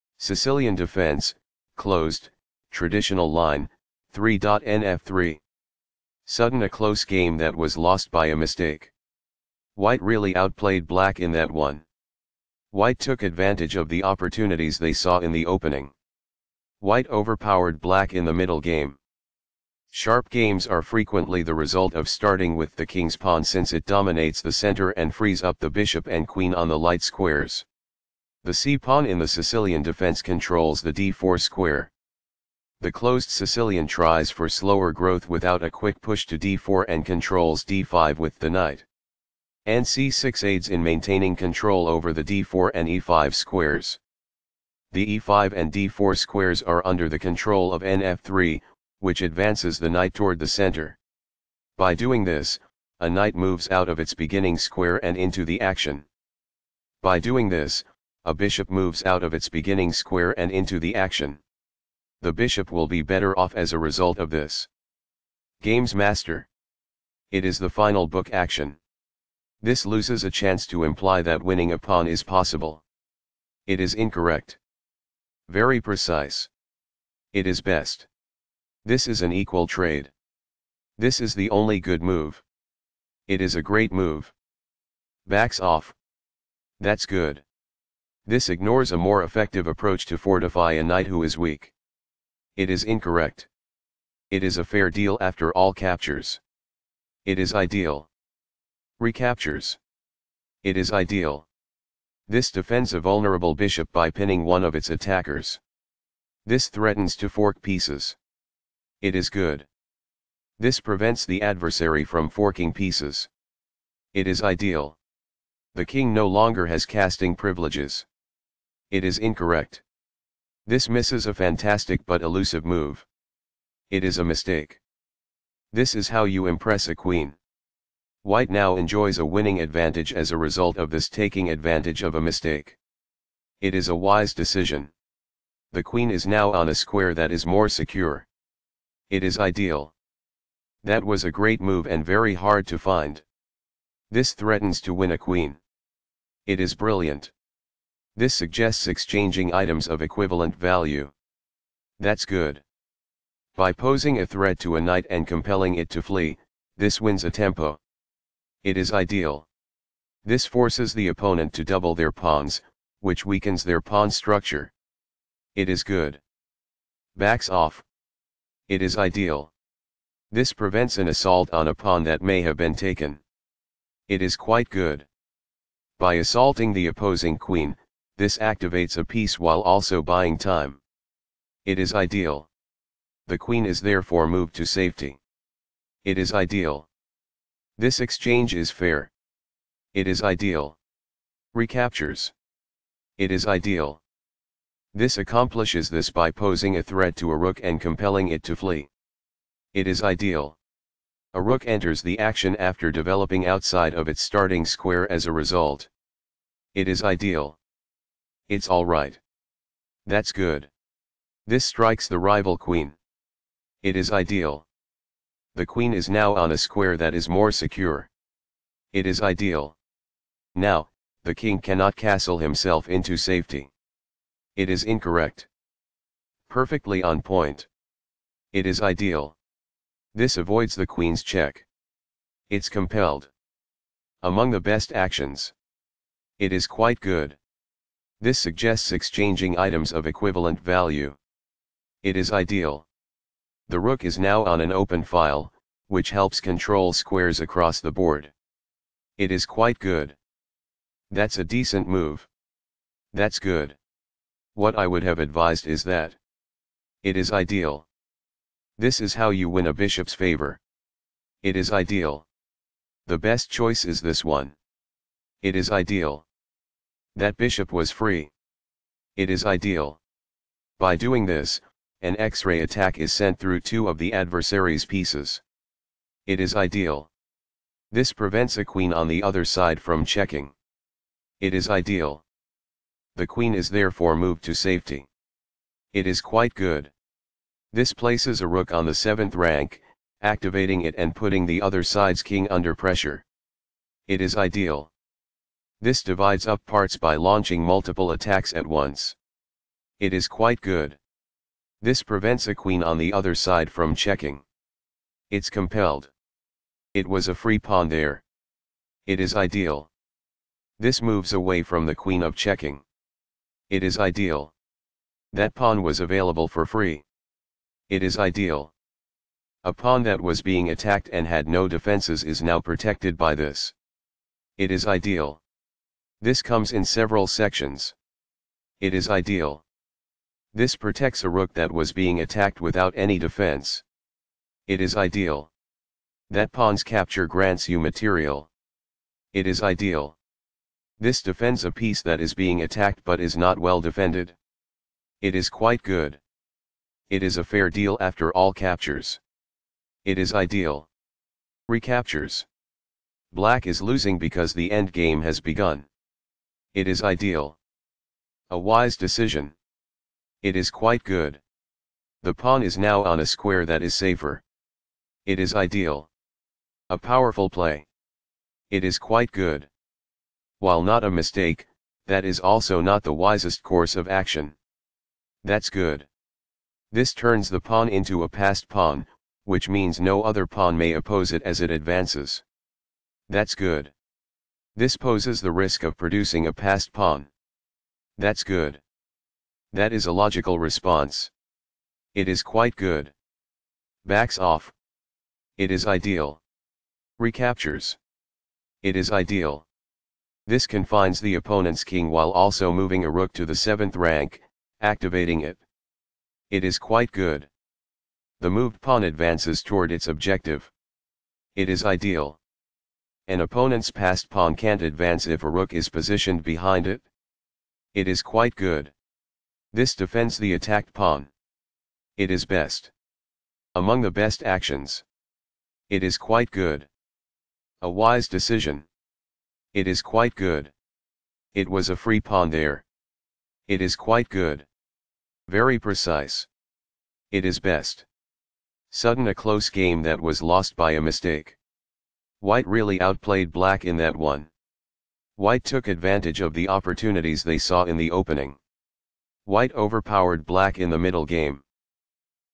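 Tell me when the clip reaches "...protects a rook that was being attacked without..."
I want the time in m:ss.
5:30.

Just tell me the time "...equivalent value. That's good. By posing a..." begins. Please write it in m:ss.
2:30.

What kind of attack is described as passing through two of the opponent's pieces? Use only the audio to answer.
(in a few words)
X-ray attack.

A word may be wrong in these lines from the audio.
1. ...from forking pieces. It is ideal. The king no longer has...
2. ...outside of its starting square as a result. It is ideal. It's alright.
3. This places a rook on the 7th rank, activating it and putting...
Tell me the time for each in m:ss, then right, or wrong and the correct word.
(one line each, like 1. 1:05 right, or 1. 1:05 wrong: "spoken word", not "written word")
1. 1:52 right
2. 3:23 right
3. 4:47 right.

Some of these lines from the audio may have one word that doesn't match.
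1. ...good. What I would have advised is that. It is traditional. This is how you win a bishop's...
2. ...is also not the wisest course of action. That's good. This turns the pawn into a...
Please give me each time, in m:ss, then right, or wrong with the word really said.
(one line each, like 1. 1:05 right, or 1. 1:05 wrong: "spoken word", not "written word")
1. 4:13 wrong: "ideal", not "traditional"
2. 6:12 right.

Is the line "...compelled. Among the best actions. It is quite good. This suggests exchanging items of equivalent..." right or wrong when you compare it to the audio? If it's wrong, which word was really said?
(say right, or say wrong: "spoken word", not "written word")
right.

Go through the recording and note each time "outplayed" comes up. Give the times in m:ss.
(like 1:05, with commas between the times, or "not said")
0:10, 7:22.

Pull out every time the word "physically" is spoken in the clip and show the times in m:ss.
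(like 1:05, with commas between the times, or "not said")
not said.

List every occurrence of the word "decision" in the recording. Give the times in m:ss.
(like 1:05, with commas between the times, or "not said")
2:14, 5:58, 7:08.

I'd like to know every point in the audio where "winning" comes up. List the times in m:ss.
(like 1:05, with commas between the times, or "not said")
1:11, 2:09.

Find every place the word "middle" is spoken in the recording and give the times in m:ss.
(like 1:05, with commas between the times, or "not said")
0:18, 7:30.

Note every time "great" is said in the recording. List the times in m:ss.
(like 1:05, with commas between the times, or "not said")
1:23, 2:21.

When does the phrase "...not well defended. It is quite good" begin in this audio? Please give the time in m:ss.
5:43.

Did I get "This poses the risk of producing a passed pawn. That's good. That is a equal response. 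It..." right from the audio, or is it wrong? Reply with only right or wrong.
wrong.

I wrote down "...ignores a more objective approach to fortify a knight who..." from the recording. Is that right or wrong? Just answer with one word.
wrong.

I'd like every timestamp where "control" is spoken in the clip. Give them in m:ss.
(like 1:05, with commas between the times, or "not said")
0:30, 0:37, 0:41, 0:47, 4:06.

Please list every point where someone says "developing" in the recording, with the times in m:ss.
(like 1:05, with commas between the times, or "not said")
3:22.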